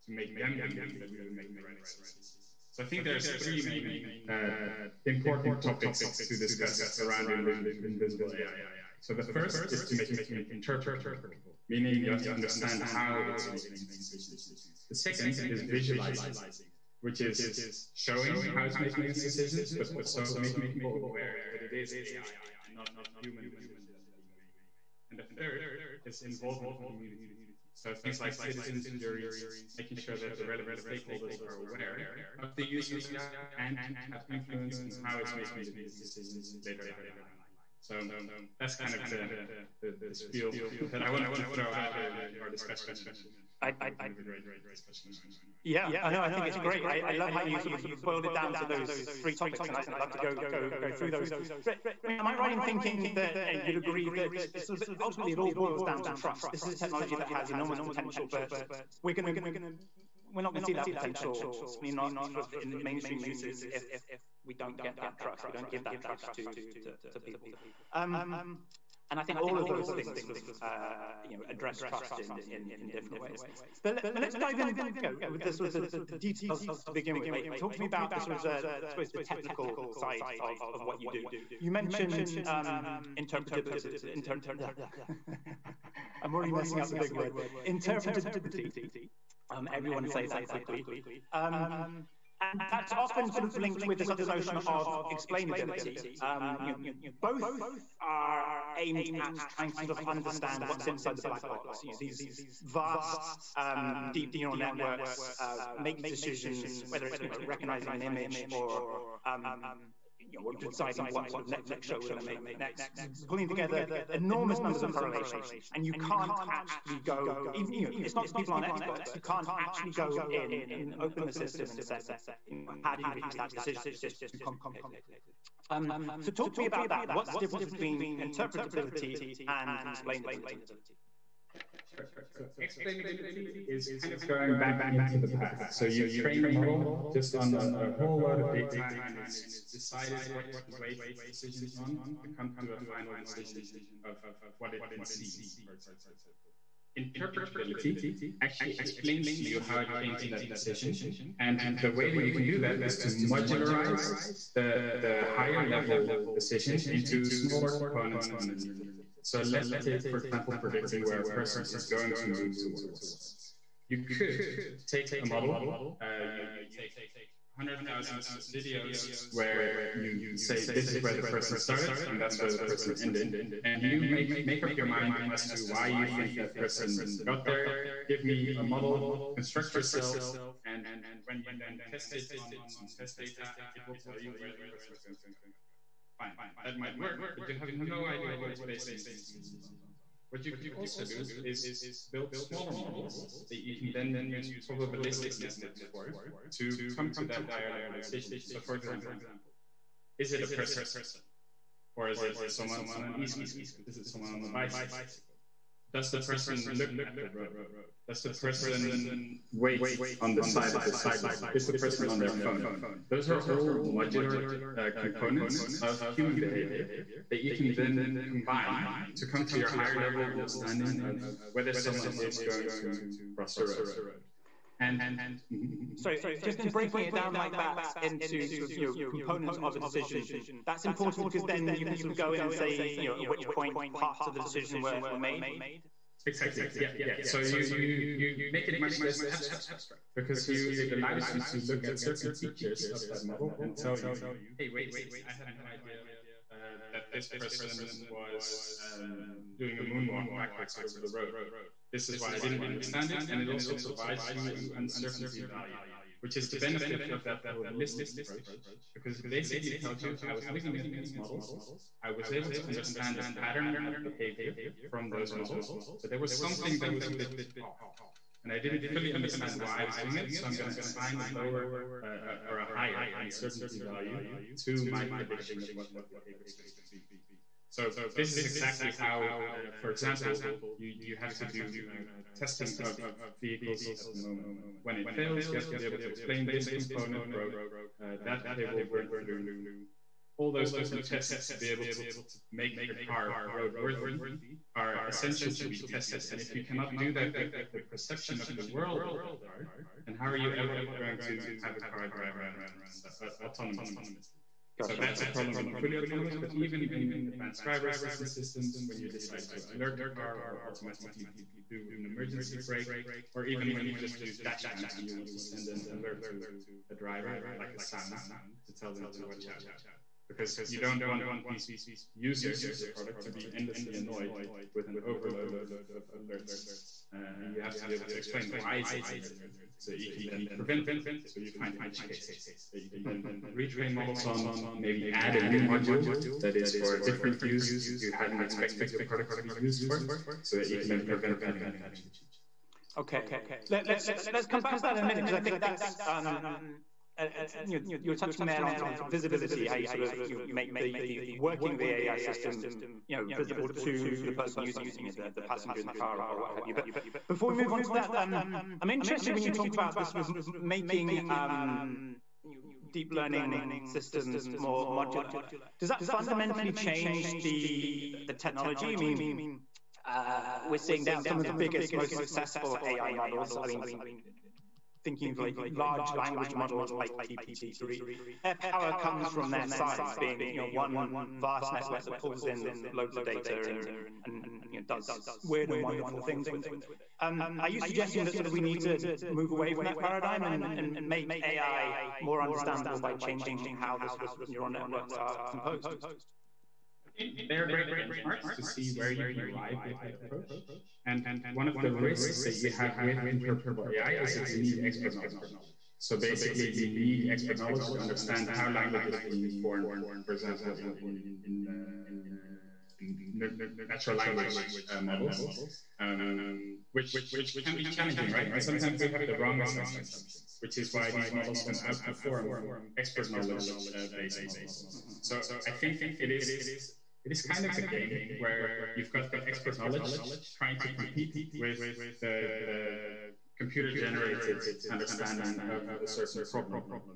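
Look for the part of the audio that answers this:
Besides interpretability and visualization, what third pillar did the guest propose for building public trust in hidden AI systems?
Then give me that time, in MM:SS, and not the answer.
00:26.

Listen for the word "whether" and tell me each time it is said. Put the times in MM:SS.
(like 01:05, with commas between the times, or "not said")
01:46, 03:41.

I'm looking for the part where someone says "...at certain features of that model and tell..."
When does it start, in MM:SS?
04:01.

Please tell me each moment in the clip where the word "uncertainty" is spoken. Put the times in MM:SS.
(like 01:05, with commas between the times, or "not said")
04:14, 04:33.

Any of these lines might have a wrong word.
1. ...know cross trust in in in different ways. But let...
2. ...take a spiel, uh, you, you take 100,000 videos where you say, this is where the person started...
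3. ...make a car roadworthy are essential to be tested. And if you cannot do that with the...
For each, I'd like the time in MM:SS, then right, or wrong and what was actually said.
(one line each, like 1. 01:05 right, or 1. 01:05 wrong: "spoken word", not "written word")
1. 01:11 wrong: "address", not "cross"
2. 02:44 wrong: "model", not "spiel"
3. 04:52 right.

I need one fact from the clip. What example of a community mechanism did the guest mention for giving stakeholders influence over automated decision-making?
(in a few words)
Citizens juries.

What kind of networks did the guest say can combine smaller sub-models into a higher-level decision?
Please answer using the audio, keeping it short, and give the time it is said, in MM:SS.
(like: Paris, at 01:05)
Probabilistic networks, at 03:14.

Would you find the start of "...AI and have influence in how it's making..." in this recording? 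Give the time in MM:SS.
00:33.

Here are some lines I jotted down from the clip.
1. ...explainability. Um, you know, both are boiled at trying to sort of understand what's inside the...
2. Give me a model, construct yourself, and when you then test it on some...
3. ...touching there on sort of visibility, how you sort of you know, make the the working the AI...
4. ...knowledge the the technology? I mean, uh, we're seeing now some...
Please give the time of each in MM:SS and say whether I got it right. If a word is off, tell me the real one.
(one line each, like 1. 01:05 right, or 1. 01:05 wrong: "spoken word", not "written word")
1. 01:35 wrong: "aimed", not "boiled"
2. 02:58 right
3. 05:48 right
4. 06:06 wrong: "change", not "knowledge".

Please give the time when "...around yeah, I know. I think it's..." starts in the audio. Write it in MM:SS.
00:45.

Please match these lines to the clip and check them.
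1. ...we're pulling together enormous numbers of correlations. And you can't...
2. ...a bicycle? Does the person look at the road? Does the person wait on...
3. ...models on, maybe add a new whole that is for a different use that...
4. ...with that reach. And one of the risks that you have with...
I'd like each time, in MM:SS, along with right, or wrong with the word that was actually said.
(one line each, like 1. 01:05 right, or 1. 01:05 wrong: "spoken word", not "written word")
1. 01:53 right
2. 03:24 right
3. 05:33 wrong: "module", not "whole"
4. 06:39 wrong: "approach", not "reach".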